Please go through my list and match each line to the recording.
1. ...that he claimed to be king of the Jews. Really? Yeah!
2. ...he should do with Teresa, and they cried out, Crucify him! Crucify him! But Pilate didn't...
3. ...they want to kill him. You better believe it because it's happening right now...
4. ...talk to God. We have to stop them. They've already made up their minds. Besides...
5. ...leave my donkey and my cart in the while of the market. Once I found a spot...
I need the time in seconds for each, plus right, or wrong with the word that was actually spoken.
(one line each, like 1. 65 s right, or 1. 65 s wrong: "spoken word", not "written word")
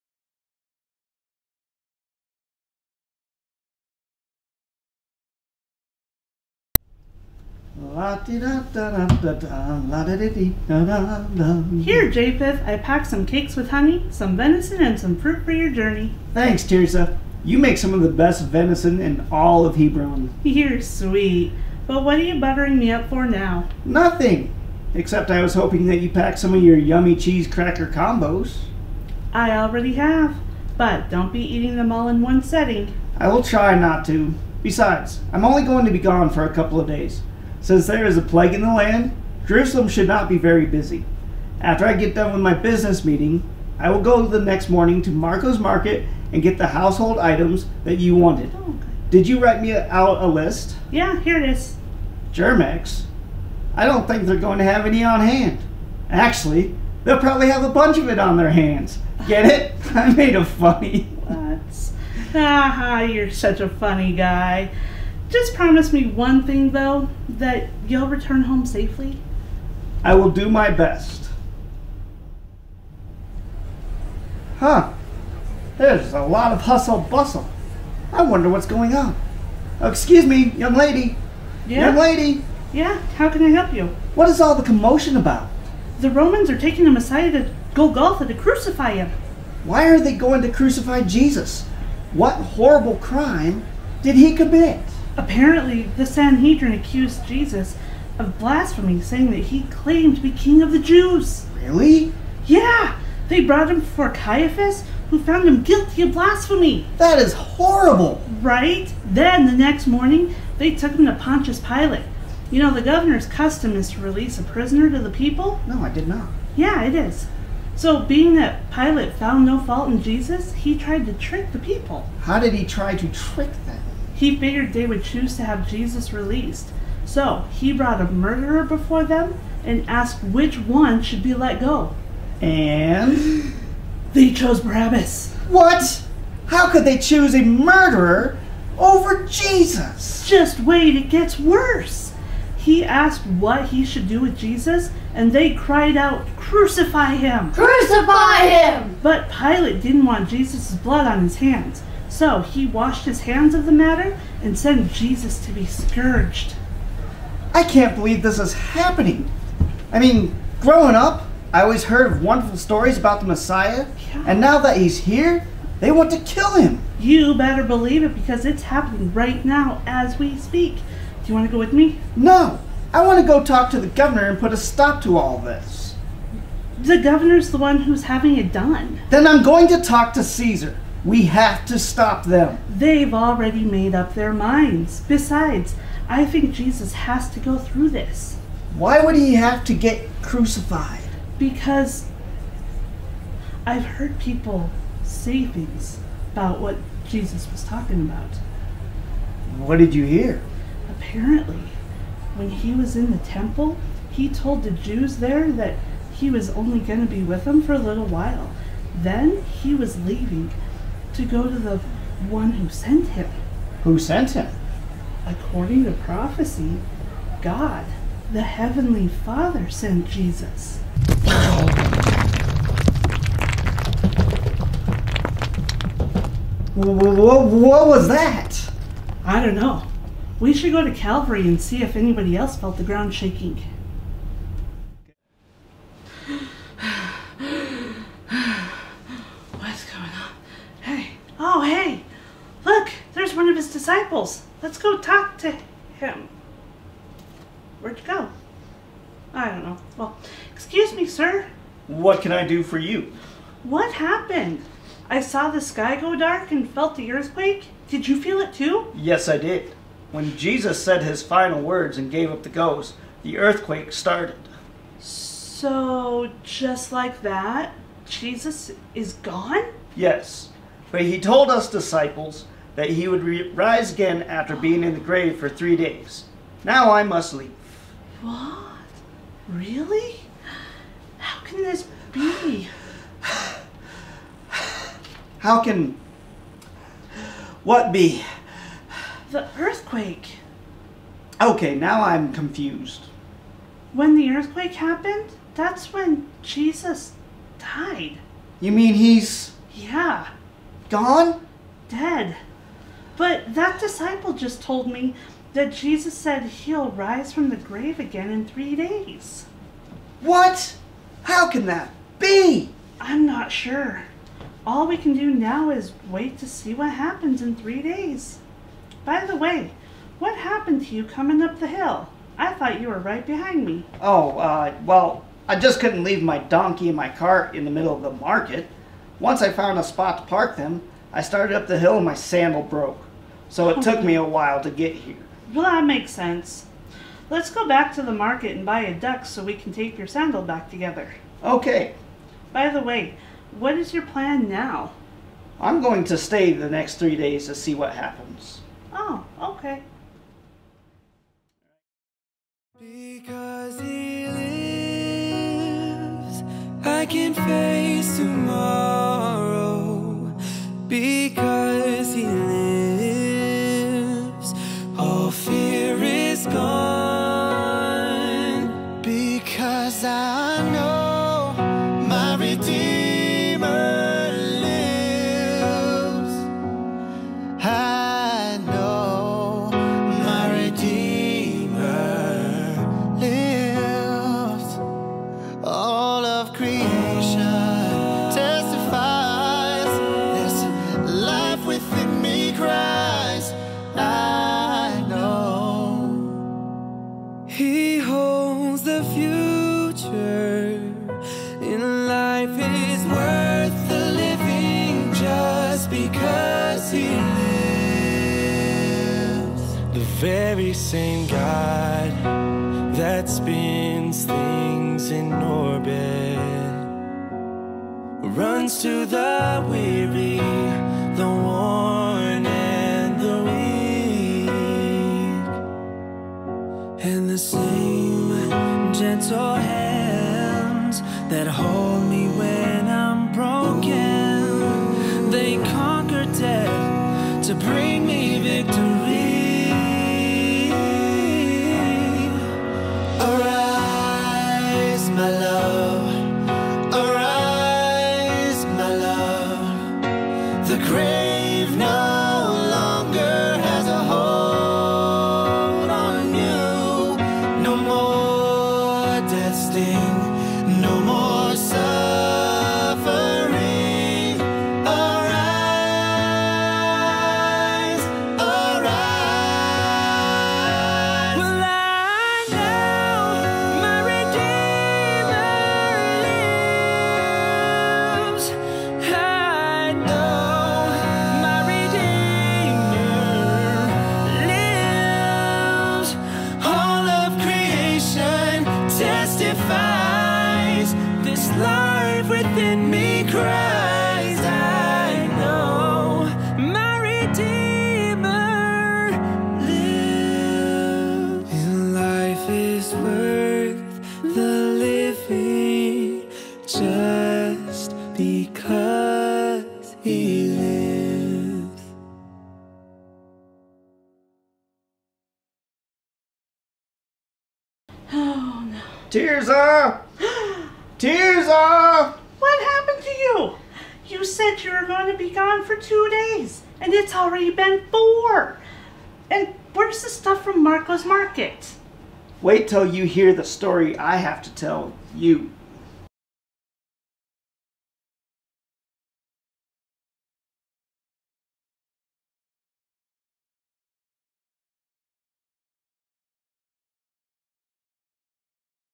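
1. 99 s right
2. 143 s wrong: "Jesus", not "Teresa"
3. 165 s right
4. 179 s wrong: "Caesar", not "God"
5. 326 s wrong: "middle", not "while".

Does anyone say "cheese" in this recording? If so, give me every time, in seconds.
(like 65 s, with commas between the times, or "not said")
27 s.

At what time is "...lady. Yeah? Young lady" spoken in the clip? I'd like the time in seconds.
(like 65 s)
80 s.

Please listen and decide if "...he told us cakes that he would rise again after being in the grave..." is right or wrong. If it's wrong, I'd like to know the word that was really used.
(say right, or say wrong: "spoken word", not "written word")
wrong: "disciples", not "cakes".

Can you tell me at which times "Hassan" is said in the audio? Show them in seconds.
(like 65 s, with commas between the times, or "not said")
not said.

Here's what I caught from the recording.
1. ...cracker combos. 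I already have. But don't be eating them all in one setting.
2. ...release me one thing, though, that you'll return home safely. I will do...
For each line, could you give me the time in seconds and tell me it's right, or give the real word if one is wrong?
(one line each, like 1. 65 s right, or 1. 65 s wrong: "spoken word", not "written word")
1. 27 s right
2. 65 s wrong: "promise", not "release".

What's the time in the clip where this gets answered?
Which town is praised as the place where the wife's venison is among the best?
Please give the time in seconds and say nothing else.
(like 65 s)
19 s.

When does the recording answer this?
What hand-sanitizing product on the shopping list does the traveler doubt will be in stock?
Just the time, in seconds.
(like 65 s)
52 s.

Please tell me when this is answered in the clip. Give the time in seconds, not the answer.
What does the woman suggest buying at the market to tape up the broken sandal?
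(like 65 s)
338 s.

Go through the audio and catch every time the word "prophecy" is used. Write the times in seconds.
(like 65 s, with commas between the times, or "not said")
215 s.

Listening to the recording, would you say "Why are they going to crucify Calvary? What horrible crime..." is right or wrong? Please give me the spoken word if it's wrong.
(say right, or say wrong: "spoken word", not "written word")
wrong: "Jesus", not "Calvary".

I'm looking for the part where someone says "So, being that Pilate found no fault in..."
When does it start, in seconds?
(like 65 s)
117 s.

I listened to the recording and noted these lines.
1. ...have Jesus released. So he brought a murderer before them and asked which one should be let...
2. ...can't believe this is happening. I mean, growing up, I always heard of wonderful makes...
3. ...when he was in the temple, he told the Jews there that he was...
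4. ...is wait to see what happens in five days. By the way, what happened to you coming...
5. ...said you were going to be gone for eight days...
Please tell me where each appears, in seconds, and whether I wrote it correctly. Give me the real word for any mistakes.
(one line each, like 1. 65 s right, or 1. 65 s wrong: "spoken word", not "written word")
1. 125 s right
2. 157 s wrong: "stories", not "makes"
3. 202 s right
4. 315 s wrong: "three", not "five"
5. 524 s wrong: "two", not "eight".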